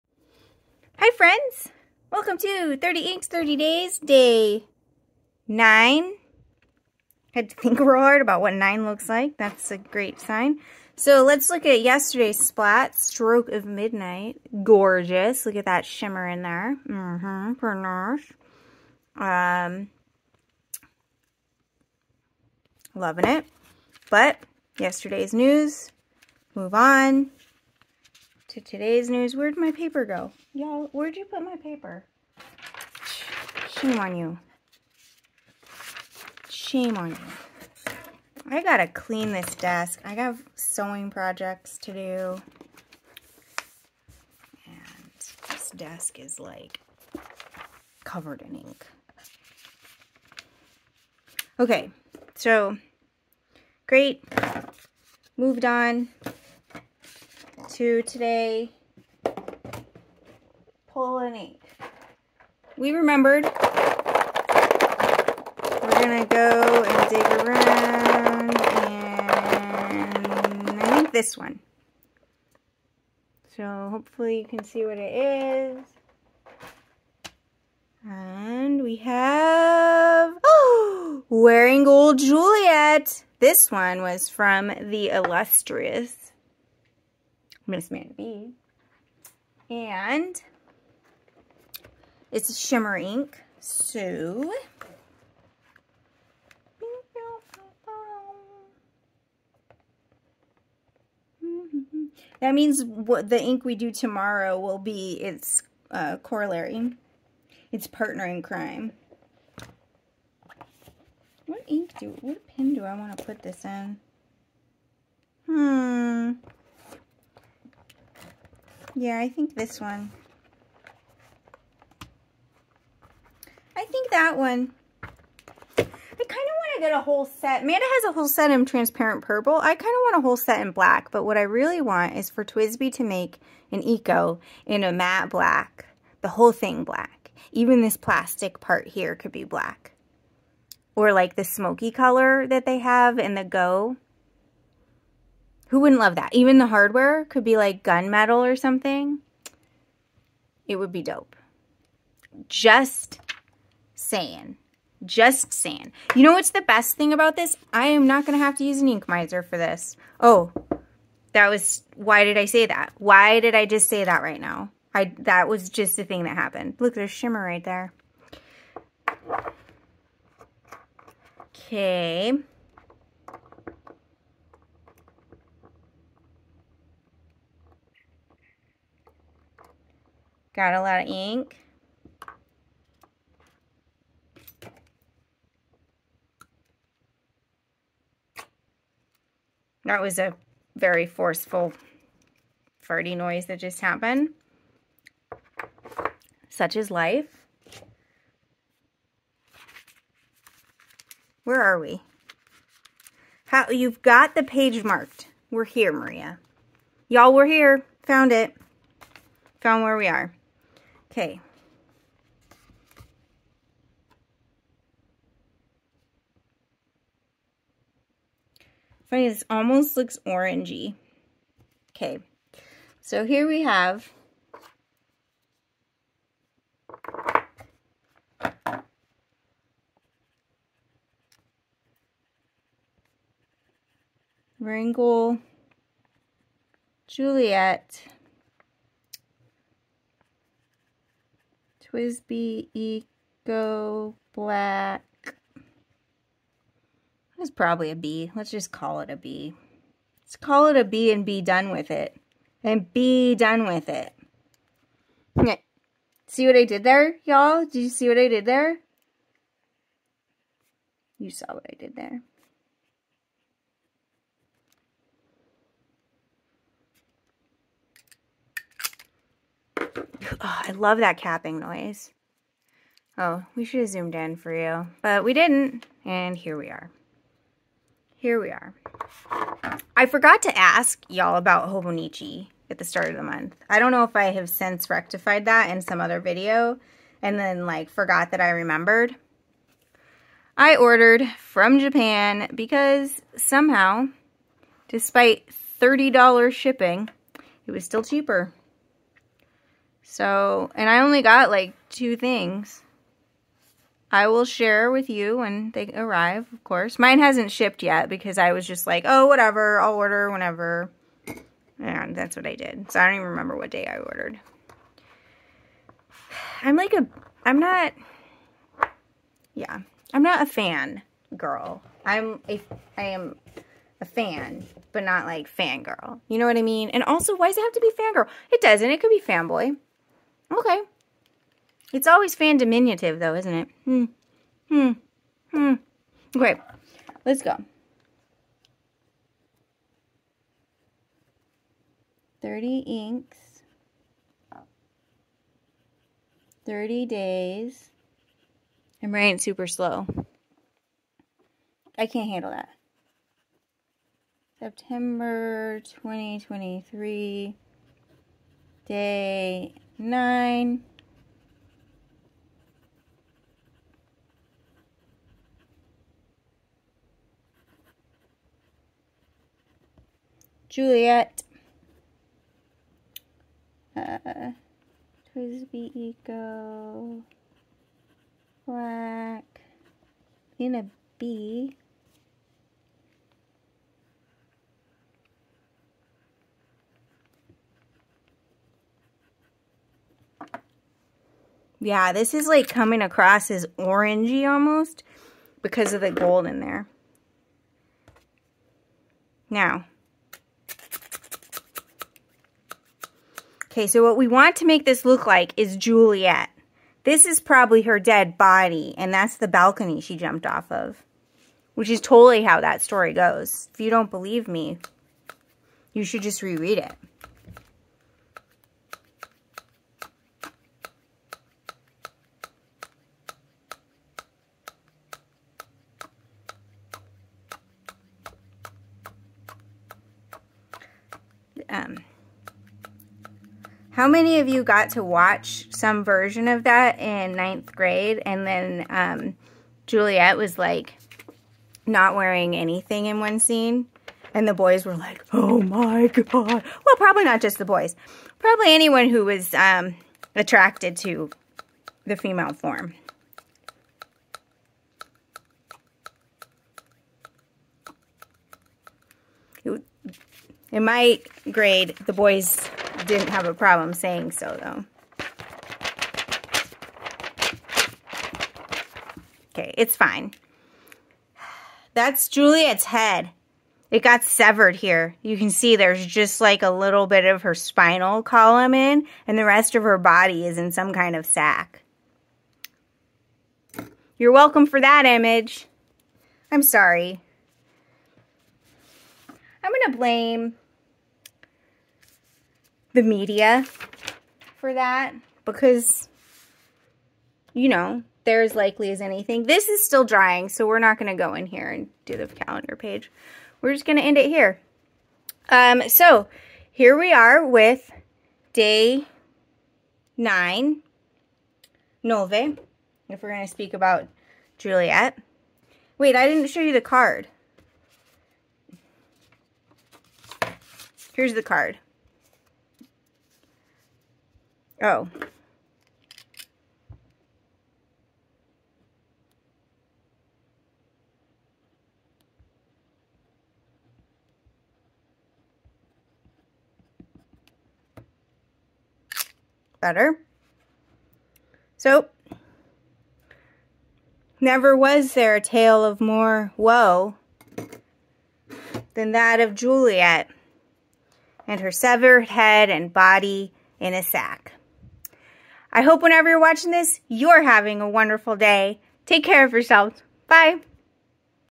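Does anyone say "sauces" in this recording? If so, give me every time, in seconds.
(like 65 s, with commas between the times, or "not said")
not said.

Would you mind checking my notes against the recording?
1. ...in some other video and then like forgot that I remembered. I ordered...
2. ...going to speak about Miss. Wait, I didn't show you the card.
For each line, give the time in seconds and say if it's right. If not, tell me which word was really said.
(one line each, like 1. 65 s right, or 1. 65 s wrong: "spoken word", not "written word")
1. 285 s right
2. 513 s wrong: "Juliet", not "Miss".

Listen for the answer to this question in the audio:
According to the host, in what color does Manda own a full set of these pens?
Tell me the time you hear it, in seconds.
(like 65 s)
128 s.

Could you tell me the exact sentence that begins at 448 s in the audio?
Probably anyone who was um, attracted to the female form.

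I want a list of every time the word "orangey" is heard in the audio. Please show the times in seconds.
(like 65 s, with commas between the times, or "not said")
220 s, 393 s.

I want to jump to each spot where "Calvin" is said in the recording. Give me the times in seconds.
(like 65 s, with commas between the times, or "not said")
not said.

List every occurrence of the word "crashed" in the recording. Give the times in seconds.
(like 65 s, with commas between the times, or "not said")
not said.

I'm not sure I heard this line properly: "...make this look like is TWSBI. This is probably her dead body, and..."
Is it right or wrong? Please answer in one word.
wrong.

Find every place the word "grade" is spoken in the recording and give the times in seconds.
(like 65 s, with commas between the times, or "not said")
437 s, 461 s.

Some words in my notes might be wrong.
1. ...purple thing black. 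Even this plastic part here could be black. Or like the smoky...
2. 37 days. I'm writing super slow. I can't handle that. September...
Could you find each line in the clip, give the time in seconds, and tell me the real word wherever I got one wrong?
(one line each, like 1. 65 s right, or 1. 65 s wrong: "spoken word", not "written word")
1. 136 s wrong: "whole", not "purple"
2. 346 s wrong: "30", not "37".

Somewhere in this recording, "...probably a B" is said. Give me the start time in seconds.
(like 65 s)
247 s.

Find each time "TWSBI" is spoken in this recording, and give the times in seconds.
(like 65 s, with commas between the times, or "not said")
132 s, 241 s, 375 s.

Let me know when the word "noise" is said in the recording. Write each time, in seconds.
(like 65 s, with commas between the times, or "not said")
193 s, 271 s.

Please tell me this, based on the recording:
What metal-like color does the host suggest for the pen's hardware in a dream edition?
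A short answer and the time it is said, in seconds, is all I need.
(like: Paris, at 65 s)
gunmetal, at 147 s.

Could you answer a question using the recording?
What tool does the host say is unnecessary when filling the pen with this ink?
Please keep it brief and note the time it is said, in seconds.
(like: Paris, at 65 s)
ink miser, at 158 s.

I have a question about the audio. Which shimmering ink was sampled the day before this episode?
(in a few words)
Stroke of Midnight.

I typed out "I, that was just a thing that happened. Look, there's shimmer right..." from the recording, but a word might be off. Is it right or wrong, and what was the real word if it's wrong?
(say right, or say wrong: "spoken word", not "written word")
right.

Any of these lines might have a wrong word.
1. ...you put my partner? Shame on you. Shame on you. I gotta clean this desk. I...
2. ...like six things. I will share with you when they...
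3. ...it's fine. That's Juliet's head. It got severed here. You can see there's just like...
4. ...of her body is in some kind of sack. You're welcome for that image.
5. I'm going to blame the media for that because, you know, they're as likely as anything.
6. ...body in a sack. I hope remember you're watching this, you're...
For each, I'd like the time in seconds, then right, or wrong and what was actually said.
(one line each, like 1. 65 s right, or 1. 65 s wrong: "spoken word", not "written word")
1. 31 s wrong: "paper", not "partner"
2. 301 s wrong: "two", not "six"
3. 469 s right
4. 479 s right
5. 489 s right
6. 552 s wrong: "whenever", not "remember".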